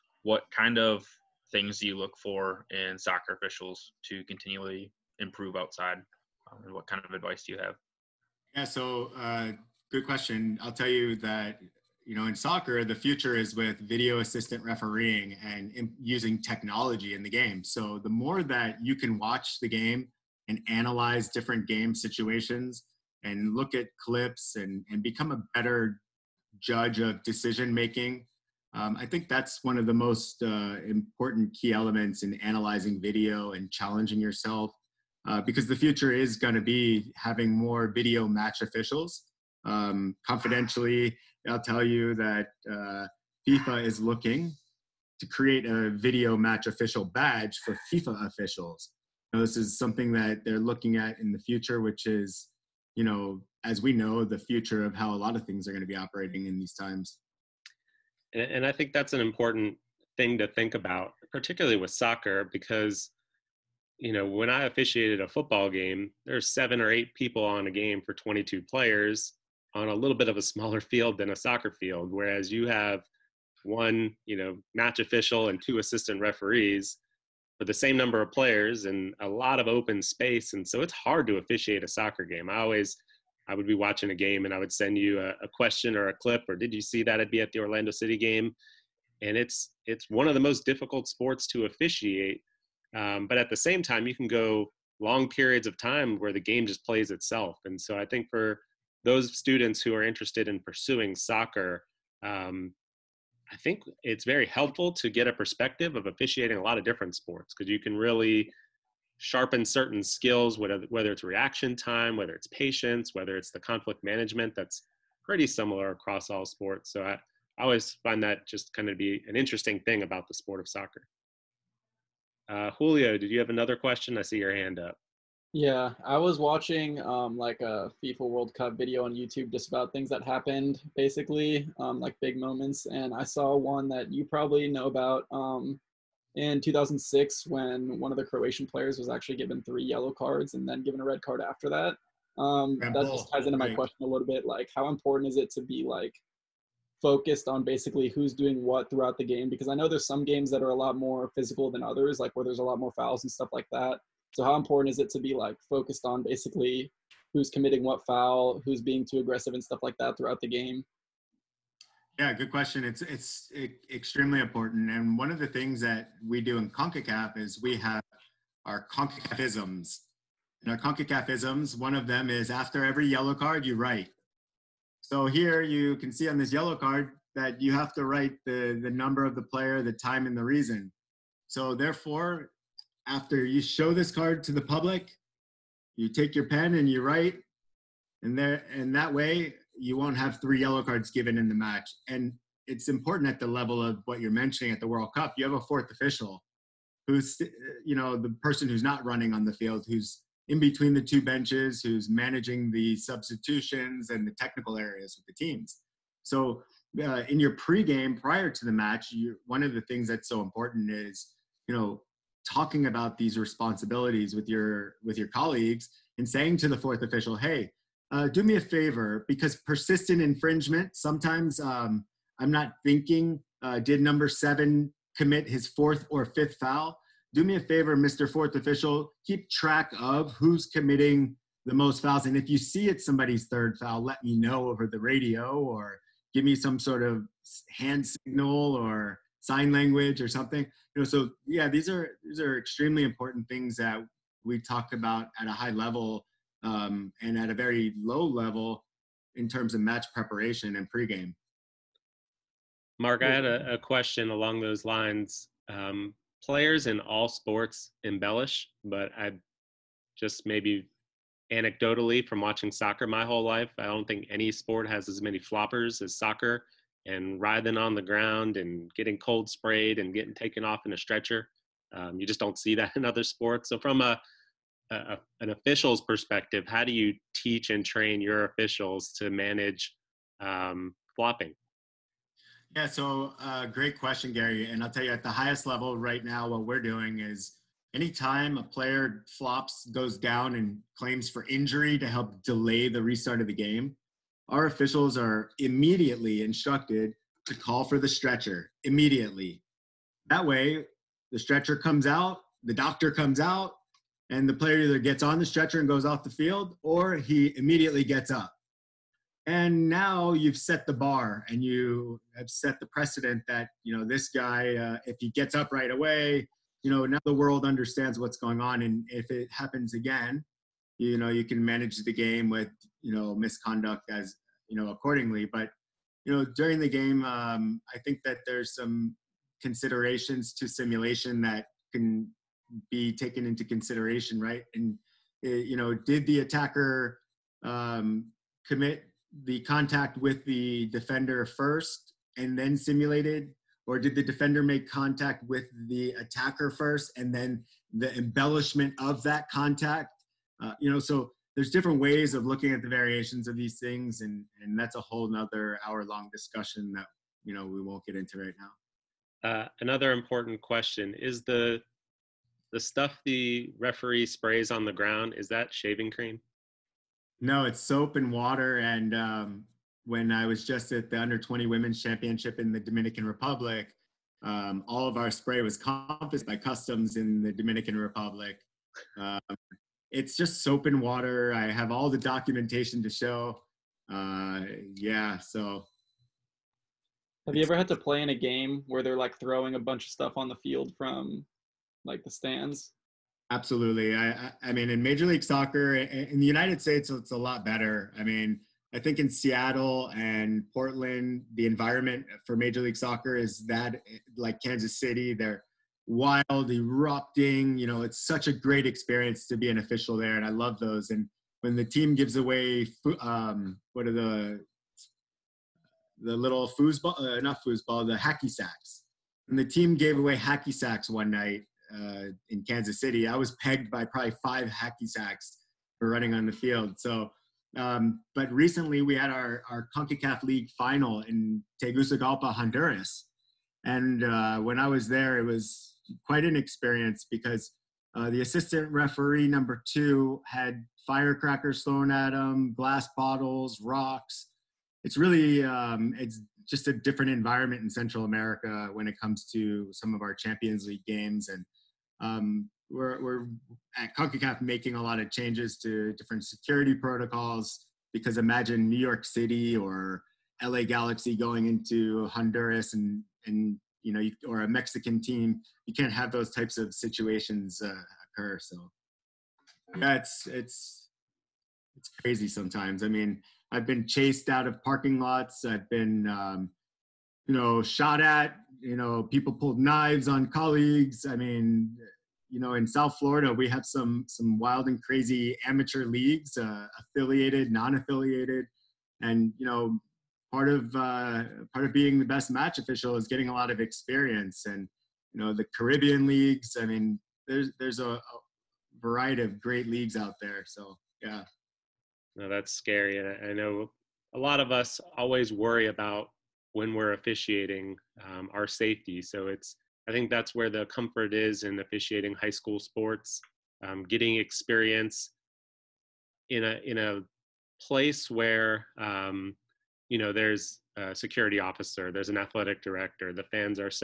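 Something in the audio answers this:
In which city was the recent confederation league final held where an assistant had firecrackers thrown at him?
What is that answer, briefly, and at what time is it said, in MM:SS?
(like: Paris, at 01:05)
Tegucigalpa, at 07:11.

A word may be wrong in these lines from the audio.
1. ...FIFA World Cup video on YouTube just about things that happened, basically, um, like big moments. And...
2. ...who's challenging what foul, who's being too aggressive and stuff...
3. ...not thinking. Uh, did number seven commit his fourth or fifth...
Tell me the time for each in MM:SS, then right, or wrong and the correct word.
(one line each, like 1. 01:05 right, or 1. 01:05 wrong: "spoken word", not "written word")
1. 02:08 right
2. 02:37 wrong: "committing", not "challenging"
3. 03:42 right.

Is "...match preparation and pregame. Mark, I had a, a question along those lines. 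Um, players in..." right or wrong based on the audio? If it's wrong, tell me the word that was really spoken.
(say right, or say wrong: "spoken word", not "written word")
right.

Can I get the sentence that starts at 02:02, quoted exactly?
Uh, Julio, did you have another question?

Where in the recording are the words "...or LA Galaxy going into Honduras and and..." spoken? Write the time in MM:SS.
07:39.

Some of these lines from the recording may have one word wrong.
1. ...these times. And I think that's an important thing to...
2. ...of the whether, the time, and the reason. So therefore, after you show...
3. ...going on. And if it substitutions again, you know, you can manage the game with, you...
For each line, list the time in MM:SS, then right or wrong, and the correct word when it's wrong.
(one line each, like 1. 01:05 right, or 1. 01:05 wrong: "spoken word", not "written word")
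1. 00:56 right
2. 02:59 wrong: "player", not "whether"
3. 05:18 wrong: "happens", not "substitutions".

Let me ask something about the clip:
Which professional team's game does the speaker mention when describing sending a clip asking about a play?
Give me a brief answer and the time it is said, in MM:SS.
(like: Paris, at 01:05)
Orlando City, at 01:27.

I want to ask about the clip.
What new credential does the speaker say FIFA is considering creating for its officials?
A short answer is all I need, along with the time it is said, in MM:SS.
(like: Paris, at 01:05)
Video match official badge, at 00:45.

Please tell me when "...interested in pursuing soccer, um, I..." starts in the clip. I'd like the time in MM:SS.
01:40.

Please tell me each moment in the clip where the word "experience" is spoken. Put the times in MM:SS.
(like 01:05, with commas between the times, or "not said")
06:48, 07:16, 08:13, 08:34.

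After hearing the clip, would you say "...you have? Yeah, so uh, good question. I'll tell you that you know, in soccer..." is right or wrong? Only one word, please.
right.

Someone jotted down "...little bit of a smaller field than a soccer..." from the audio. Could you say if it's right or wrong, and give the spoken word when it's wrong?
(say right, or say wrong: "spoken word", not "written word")
right.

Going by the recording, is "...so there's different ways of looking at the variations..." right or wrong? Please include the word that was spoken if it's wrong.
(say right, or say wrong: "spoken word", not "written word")
right.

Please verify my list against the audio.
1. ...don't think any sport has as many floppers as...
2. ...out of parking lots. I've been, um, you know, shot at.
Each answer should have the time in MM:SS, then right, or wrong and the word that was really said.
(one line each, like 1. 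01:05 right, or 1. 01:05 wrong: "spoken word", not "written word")
1. 04:23 right
2. 07:54 right.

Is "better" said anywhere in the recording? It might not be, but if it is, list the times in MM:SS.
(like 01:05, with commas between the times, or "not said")
00:25, 06:37.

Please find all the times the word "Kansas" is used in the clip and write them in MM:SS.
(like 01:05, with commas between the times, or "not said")
06:44, 07:02.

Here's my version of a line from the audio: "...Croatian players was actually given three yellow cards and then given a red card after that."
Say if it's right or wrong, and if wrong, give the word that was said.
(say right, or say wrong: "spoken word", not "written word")
right.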